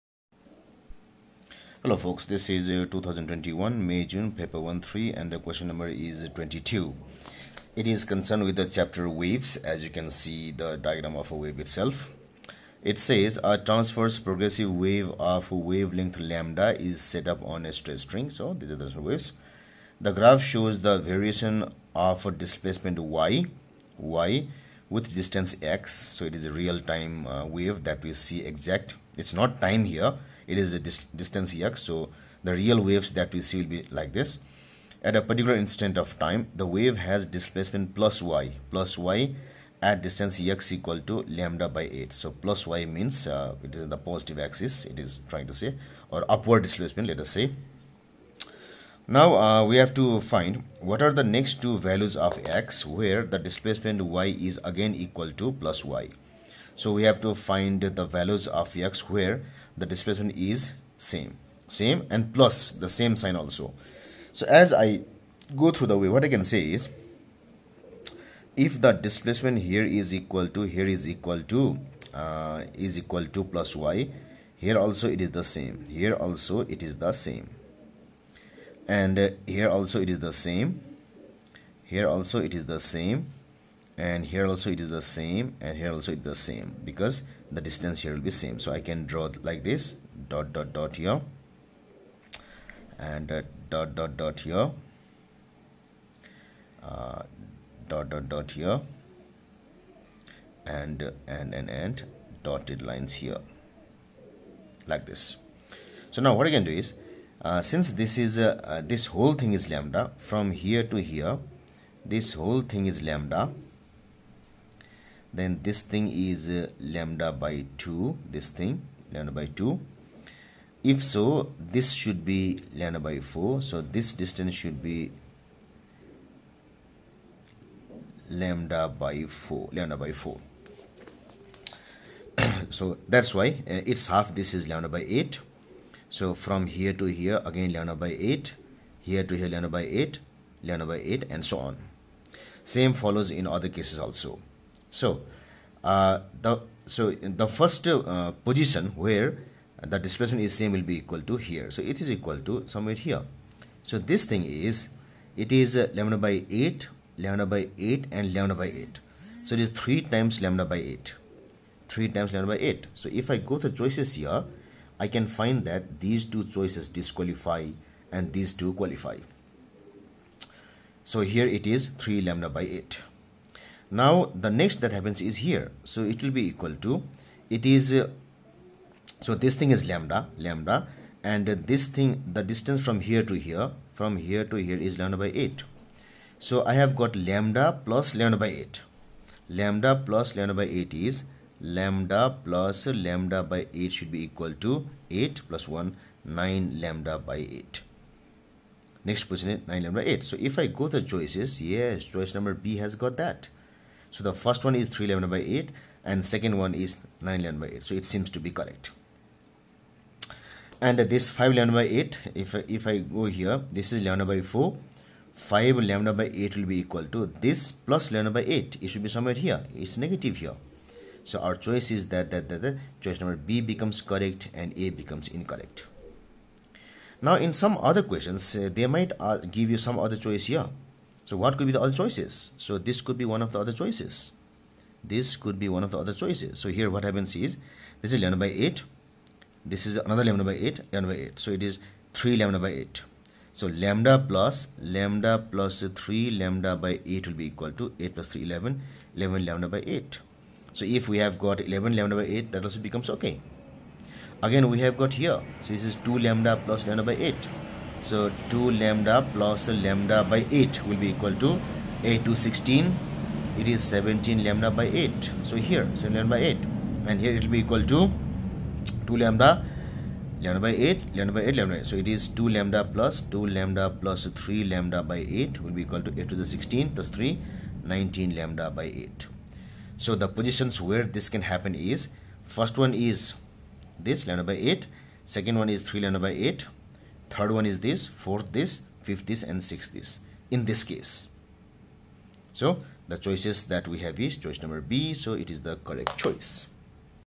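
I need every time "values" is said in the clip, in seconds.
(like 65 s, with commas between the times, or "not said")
51 s, 58 s.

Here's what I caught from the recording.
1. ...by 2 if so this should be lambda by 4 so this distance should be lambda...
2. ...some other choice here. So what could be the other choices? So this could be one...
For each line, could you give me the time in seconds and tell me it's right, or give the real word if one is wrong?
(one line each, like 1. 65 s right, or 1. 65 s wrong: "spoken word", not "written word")
1. 119 s right
2. 229 s right.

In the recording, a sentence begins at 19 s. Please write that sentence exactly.
The graph shows the variation of displacement y, y with distance x.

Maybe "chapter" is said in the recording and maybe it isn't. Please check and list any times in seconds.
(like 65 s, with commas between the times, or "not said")
8 s.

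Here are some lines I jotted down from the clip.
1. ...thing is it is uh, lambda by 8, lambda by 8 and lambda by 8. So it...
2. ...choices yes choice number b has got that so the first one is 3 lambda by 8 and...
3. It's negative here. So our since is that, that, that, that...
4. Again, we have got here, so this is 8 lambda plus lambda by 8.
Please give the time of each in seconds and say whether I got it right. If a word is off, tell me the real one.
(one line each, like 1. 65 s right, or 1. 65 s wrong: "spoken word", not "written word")
1. 154 s right
2. 201 s right
3. 219 s wrong: "choice", not "since"
4. 254 s wrong: "2", not "8".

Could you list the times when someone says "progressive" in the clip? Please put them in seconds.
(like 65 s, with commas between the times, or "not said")
14 s.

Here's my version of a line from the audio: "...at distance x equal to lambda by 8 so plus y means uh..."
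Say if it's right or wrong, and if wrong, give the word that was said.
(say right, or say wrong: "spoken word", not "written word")
right.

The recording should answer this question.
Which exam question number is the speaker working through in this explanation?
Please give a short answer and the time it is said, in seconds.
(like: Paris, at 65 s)
22, at 6 s.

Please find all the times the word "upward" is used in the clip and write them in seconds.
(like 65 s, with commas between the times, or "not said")
46 s.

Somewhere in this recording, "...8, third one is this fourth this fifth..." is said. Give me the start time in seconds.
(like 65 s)
286 s.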